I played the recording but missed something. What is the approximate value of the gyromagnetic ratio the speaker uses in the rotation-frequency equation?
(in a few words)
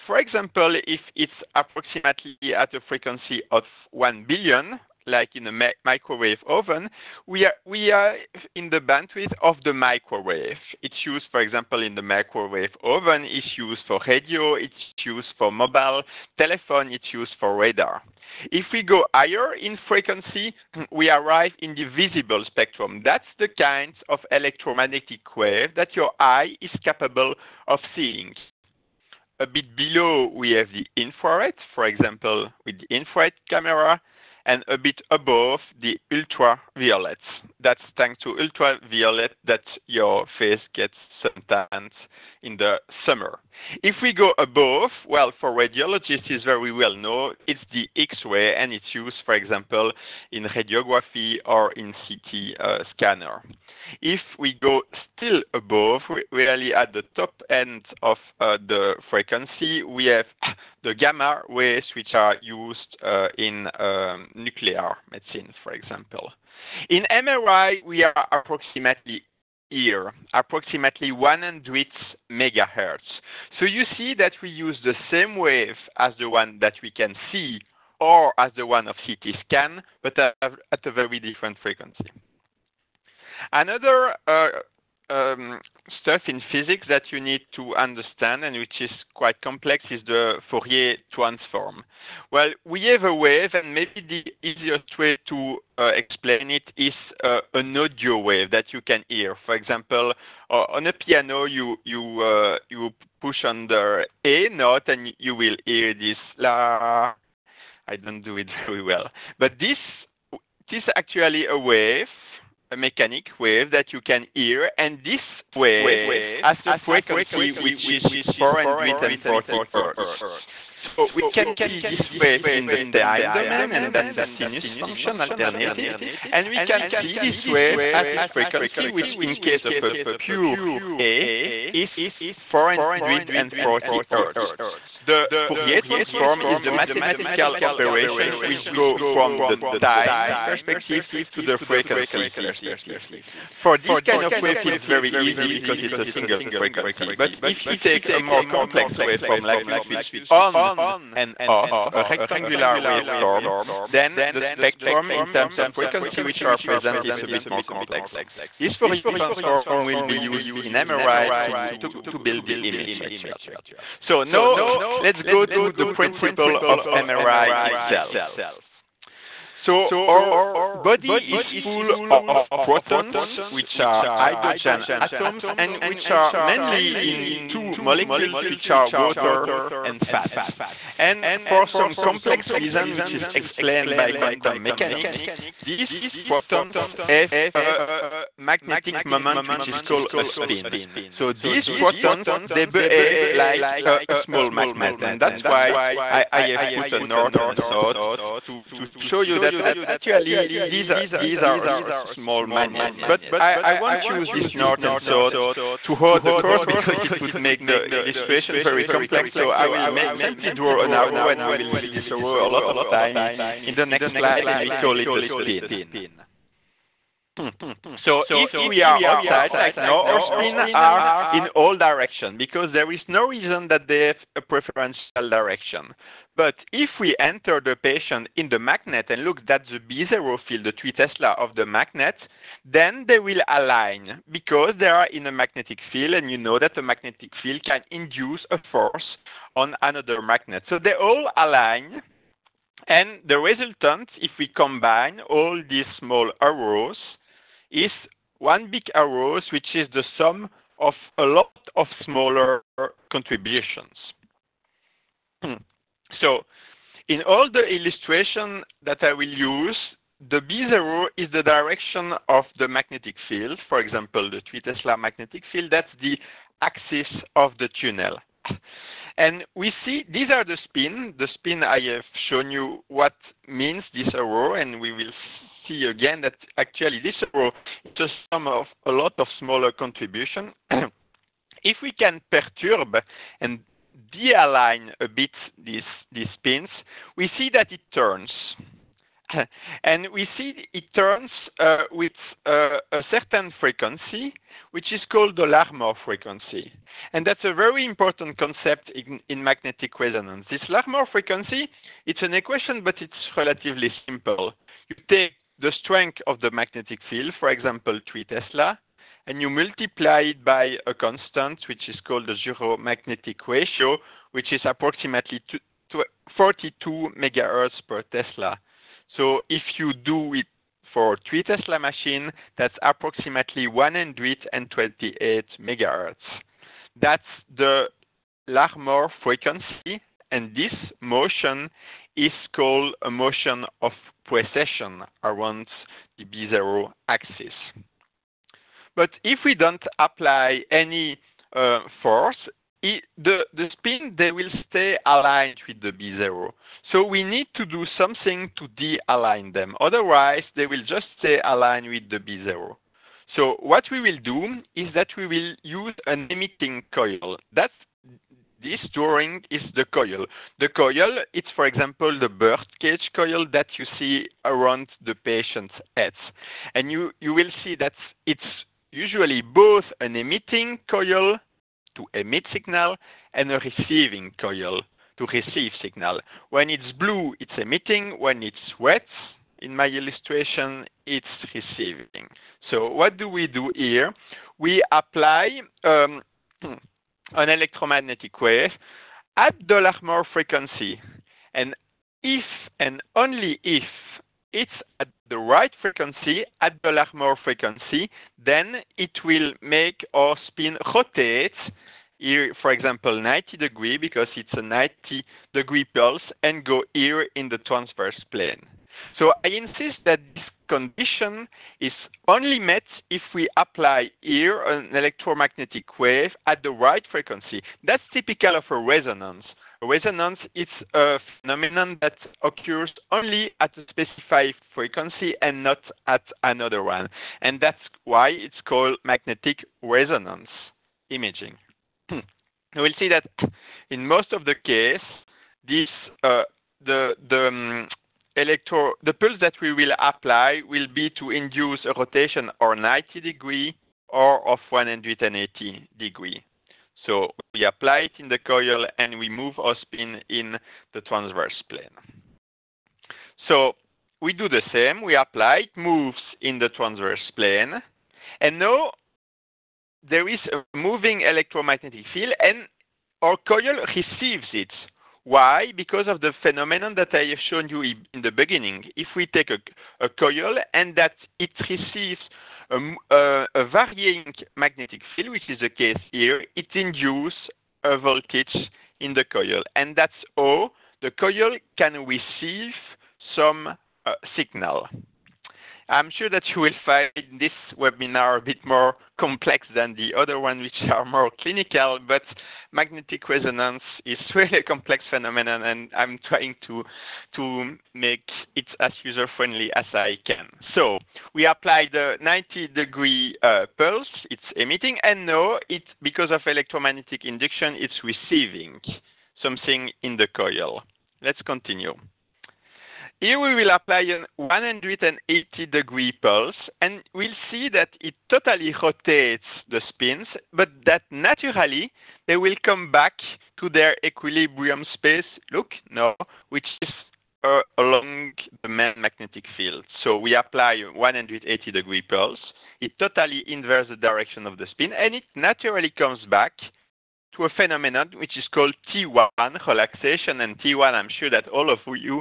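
42 MHz per Tesla.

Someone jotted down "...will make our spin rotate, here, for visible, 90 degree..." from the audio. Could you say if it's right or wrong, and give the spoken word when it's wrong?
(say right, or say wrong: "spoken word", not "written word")
wrong: "example", not "visible".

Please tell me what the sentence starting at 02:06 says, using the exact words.
And we can see this wave as its frequency, which in case of a pure A is 440 hertz.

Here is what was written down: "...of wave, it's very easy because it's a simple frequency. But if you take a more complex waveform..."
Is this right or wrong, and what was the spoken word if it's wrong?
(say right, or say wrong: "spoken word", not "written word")
wrong: "single", not "simple".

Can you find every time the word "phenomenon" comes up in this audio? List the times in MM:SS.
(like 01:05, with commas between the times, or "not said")
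07:01, 07:46, 08:15, 08:57.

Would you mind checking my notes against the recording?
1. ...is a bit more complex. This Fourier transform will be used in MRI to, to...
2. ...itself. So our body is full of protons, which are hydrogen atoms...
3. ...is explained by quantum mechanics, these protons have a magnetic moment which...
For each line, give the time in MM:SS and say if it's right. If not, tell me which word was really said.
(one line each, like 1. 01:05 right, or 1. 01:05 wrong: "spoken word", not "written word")
1. 02:37 right
2. 02:47 right
3. 03:03 right.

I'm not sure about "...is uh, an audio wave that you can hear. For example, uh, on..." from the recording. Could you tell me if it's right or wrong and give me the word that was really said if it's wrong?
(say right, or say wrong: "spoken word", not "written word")
right.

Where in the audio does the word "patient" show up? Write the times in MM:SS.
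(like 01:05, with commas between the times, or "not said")
03:47, 06:05.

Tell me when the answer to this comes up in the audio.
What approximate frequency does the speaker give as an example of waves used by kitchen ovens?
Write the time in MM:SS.
00:03.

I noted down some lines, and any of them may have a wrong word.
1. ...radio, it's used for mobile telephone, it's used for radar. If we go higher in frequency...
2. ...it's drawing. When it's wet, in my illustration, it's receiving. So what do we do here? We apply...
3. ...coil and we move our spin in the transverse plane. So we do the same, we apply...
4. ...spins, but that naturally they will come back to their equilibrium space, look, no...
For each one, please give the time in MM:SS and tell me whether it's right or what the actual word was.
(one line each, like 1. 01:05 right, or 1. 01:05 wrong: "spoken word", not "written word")
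1. 00:14 right
2. 06:17 wrong: "emitting", not "drawing"
3. 07:28 right
4. 08:39 right.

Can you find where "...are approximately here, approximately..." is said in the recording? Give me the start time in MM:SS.
01:08.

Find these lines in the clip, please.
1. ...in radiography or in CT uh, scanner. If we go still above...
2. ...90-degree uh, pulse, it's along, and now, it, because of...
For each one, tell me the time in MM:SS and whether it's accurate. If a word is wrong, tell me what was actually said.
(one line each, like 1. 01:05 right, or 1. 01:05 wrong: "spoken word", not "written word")
1. 00:50 right
2. 08:22 wrong: "emitting", not "along".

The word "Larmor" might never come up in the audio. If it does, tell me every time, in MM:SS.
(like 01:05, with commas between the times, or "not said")
04:55, 05:00, 05:28, 06:29, 06:36.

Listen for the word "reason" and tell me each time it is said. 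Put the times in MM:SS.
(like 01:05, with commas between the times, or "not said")
03:02, 03:43.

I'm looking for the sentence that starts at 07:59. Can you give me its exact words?
And that's how the coil can receive some uh, signal.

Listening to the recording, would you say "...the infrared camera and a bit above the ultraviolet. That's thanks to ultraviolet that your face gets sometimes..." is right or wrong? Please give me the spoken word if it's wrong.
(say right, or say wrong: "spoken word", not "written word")
right.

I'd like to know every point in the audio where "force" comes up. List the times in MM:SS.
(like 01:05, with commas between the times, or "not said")
03:58, 05:42.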